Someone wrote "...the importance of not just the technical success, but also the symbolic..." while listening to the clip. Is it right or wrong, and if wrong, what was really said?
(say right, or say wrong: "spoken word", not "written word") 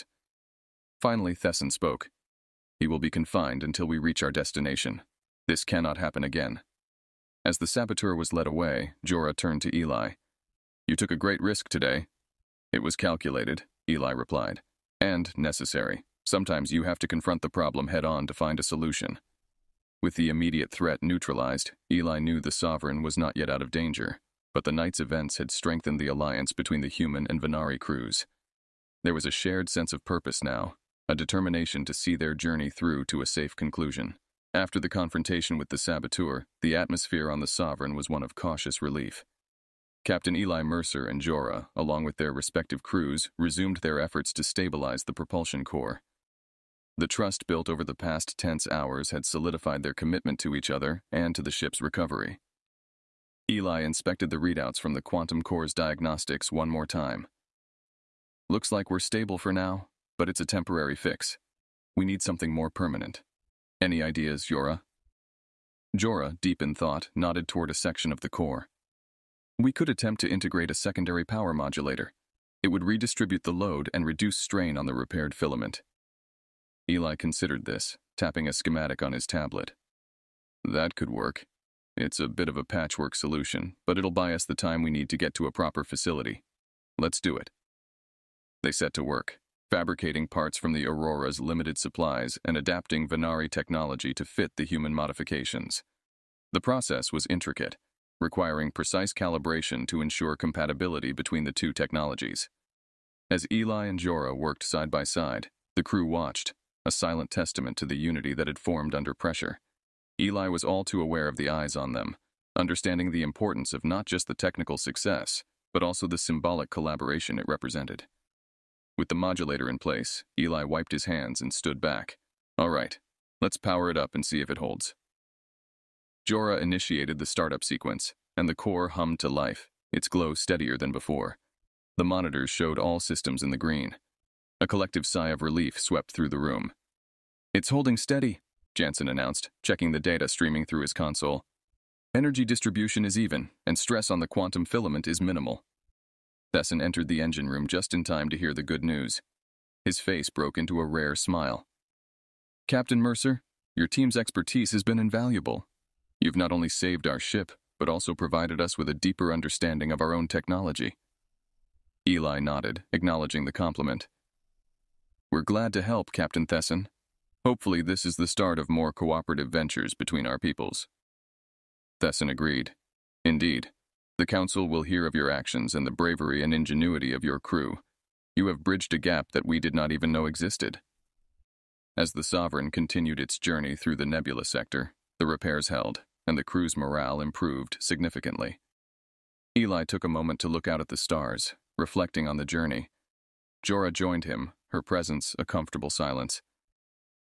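right.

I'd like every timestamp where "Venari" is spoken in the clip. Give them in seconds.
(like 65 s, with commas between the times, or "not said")
27 s, 93 s.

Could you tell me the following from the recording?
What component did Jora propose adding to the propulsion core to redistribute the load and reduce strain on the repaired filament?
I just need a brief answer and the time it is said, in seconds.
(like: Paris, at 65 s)
secondary power modulator, at 70 s.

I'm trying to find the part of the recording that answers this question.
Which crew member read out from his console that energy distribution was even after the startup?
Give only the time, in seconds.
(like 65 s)
138 s.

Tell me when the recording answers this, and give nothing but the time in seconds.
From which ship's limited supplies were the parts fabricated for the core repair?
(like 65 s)
90 s.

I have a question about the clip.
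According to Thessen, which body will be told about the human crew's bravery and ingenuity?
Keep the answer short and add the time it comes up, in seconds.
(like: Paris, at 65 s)
The Council, at 174 s.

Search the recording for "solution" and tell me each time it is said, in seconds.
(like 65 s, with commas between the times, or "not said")
18 s, 83 s.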